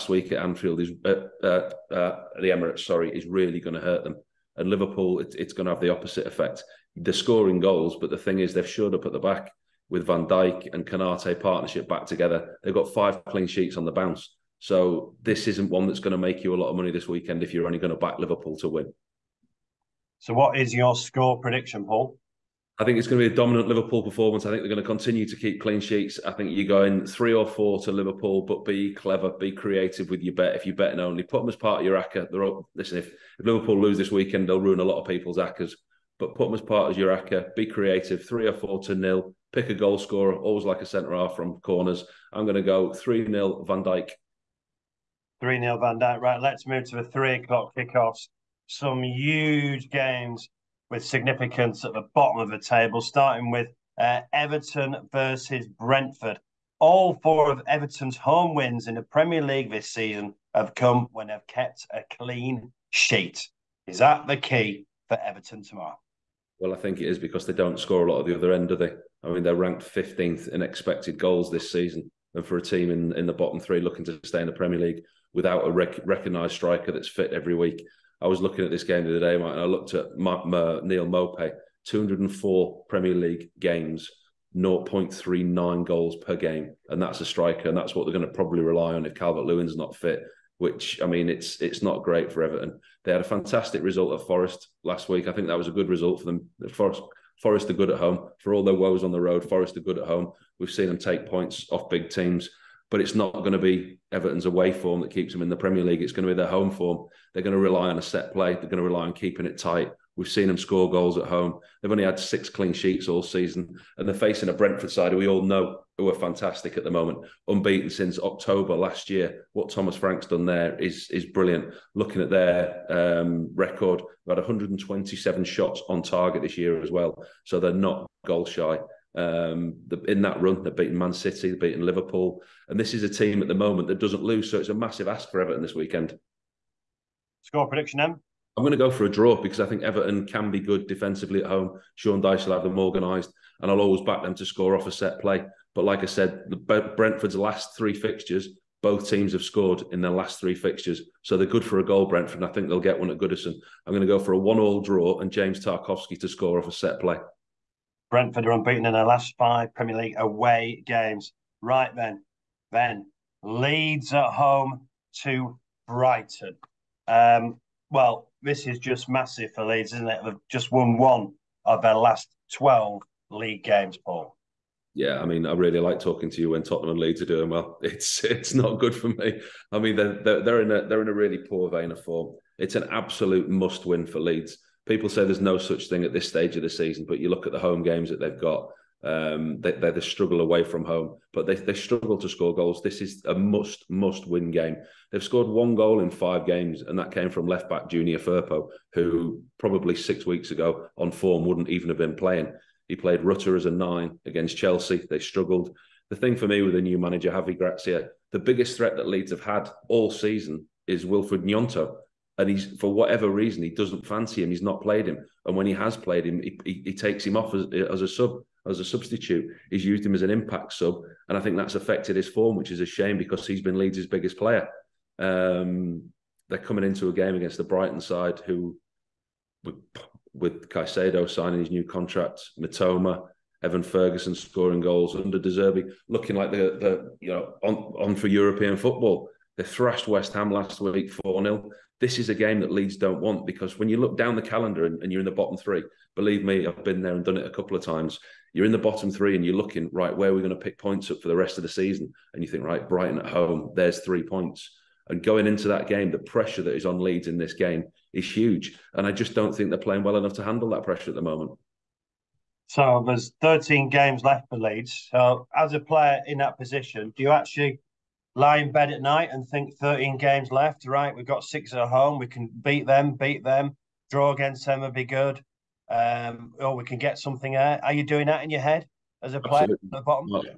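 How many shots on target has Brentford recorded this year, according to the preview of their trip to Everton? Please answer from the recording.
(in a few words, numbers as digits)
127.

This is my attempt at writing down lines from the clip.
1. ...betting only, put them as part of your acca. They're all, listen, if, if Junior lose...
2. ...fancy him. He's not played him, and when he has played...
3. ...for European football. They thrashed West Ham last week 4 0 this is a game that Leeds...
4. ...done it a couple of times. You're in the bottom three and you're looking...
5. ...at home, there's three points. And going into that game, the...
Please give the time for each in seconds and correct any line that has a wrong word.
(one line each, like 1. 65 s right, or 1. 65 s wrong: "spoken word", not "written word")
1. 30 s wrong: "Liverpool", not "Junior"
2. 214 s right
3. 238 s right
4. 247 s right
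5. 253 s right.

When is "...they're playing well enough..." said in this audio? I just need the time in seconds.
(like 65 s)
259 s.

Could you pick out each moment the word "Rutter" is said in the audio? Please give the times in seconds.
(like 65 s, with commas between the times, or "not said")
203 s.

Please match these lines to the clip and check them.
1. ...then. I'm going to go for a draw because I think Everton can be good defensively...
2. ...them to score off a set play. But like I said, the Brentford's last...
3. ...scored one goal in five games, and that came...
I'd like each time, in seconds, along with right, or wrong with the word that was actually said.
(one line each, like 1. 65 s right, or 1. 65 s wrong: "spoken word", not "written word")
1. 137 s right
2. 144 s right
3. 195 s right.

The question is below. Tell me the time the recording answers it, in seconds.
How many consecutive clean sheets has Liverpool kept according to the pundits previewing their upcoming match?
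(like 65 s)
12 s.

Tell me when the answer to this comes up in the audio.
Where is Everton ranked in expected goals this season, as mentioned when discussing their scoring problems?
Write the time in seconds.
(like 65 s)
69 s.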